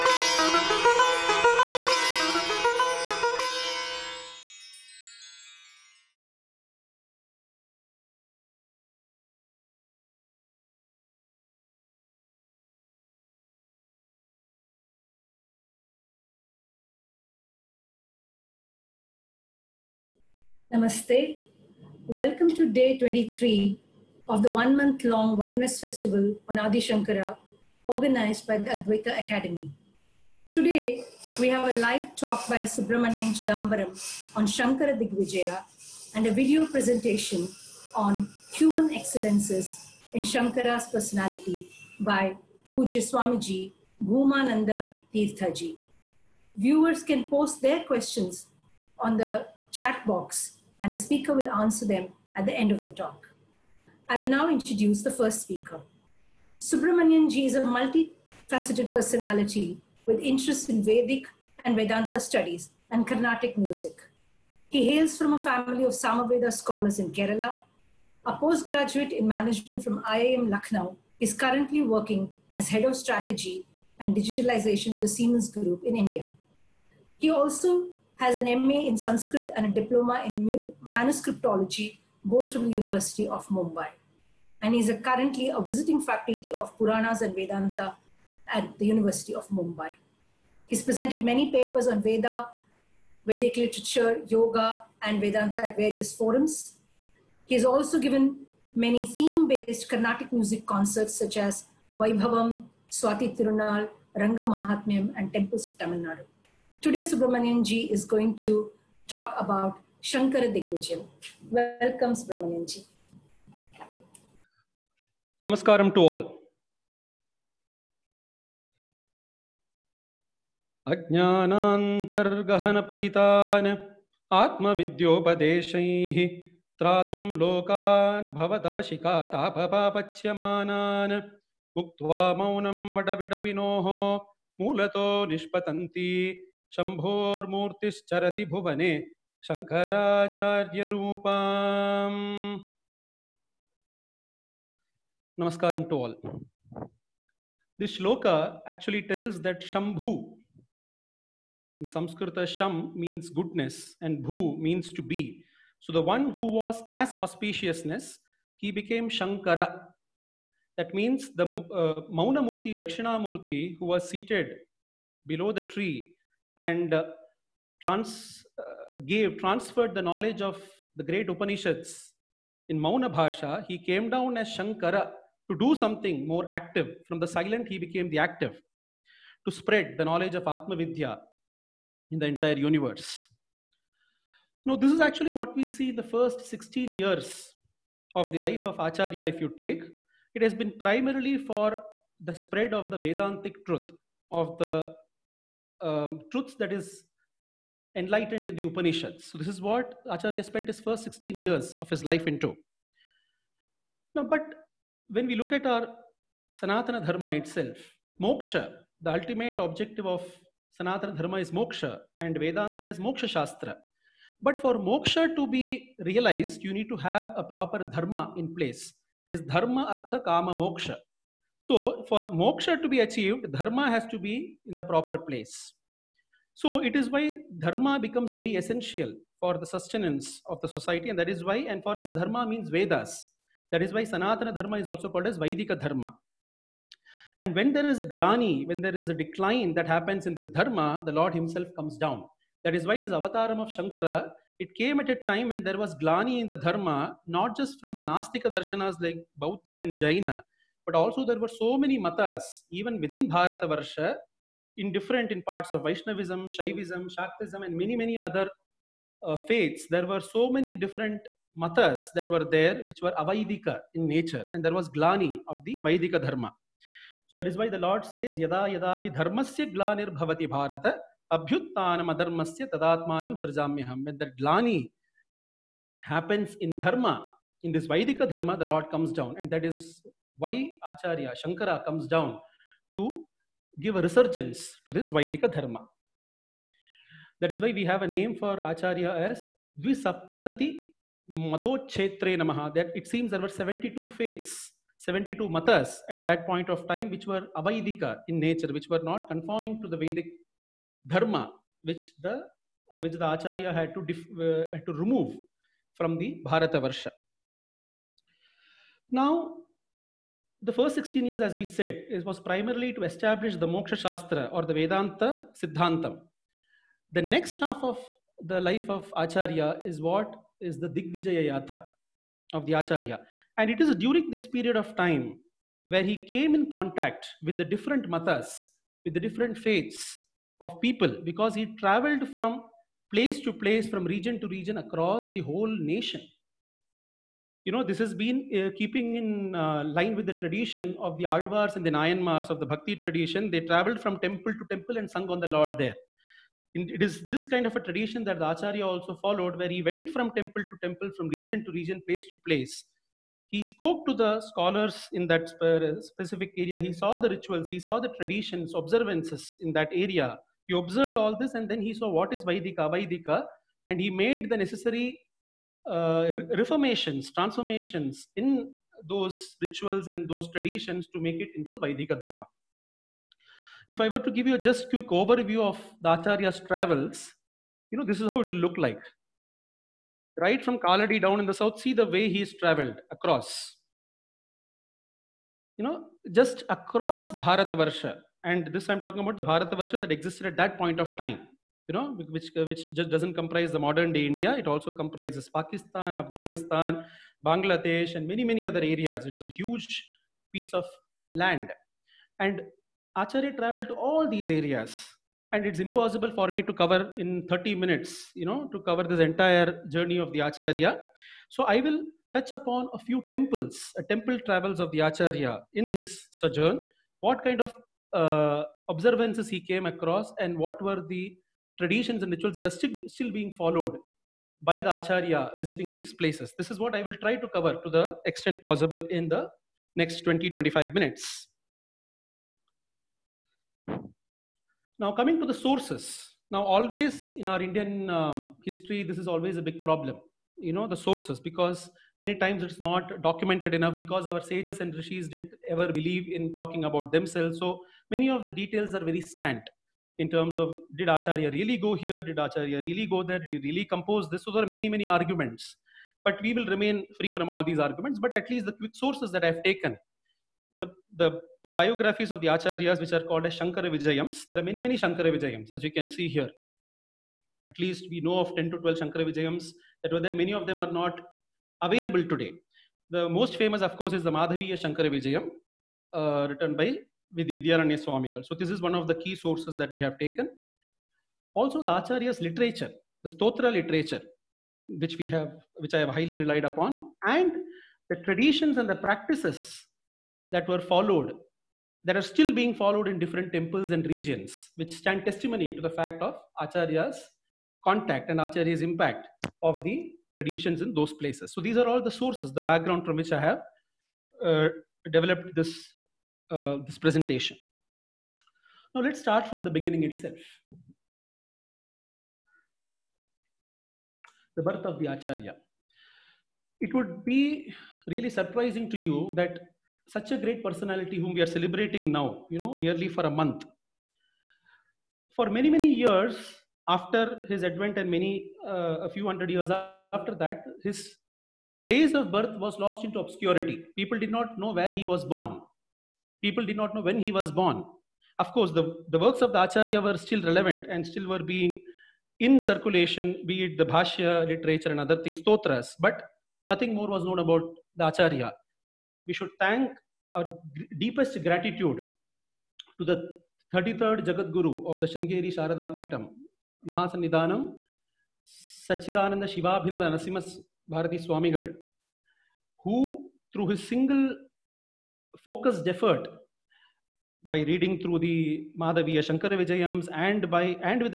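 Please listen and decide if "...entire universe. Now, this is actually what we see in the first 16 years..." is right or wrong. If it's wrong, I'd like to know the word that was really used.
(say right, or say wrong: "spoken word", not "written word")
right.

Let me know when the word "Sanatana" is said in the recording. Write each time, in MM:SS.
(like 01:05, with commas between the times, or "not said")
03:26, 03:30, 03:54.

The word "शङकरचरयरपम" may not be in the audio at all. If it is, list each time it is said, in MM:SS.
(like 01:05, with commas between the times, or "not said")
02:19.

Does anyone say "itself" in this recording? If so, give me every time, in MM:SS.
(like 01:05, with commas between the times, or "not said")
03:27, 08:30.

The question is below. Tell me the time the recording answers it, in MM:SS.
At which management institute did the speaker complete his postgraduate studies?
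01:10.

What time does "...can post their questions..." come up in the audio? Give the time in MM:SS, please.
00:47.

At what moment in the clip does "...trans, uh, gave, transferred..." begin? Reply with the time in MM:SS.
02:47.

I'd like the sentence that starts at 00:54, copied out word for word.
I will now introduce the first speaker.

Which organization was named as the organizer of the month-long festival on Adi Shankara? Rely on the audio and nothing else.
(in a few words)
Advaita Academy.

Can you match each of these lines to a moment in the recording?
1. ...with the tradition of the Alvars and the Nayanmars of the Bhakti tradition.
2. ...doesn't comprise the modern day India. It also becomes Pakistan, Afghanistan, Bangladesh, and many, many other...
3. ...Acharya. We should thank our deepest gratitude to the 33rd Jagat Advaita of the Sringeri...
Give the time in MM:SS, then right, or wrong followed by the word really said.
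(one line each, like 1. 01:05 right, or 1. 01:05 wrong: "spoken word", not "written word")
1. 05:40 right
2. 06:33 wrong: "comprises", not "becomes"
3. 09:08 wrong: "Guru", not "Advaita".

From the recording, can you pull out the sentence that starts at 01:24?
And he's a currently a visiting faculty of Puranas and Vedanta at the University of Mumbai.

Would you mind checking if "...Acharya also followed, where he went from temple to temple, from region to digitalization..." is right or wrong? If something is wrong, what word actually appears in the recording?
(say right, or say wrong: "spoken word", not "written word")
wrong: "region", not "digitalization".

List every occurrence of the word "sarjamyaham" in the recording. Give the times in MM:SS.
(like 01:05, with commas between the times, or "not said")
04:33.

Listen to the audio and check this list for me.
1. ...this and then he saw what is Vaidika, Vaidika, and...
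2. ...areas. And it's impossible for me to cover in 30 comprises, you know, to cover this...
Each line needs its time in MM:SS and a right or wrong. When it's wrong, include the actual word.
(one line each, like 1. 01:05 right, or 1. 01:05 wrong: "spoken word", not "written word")
1. 06:01 right
2. 06:44 wrong: "minutes", not "comprises".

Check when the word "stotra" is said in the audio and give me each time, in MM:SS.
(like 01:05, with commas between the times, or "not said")
08:03, 09:05.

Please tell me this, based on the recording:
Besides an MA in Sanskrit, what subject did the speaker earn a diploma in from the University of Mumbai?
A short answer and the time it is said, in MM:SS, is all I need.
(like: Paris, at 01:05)
Manuscriptology, at 01:20.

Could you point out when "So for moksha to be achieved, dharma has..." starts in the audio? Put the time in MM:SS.
03:41.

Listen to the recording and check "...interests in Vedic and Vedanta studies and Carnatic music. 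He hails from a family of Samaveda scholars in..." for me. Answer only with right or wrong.
right.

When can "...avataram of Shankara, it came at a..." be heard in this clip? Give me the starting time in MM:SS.
04:03.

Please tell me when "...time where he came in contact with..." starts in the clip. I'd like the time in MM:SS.
05:24.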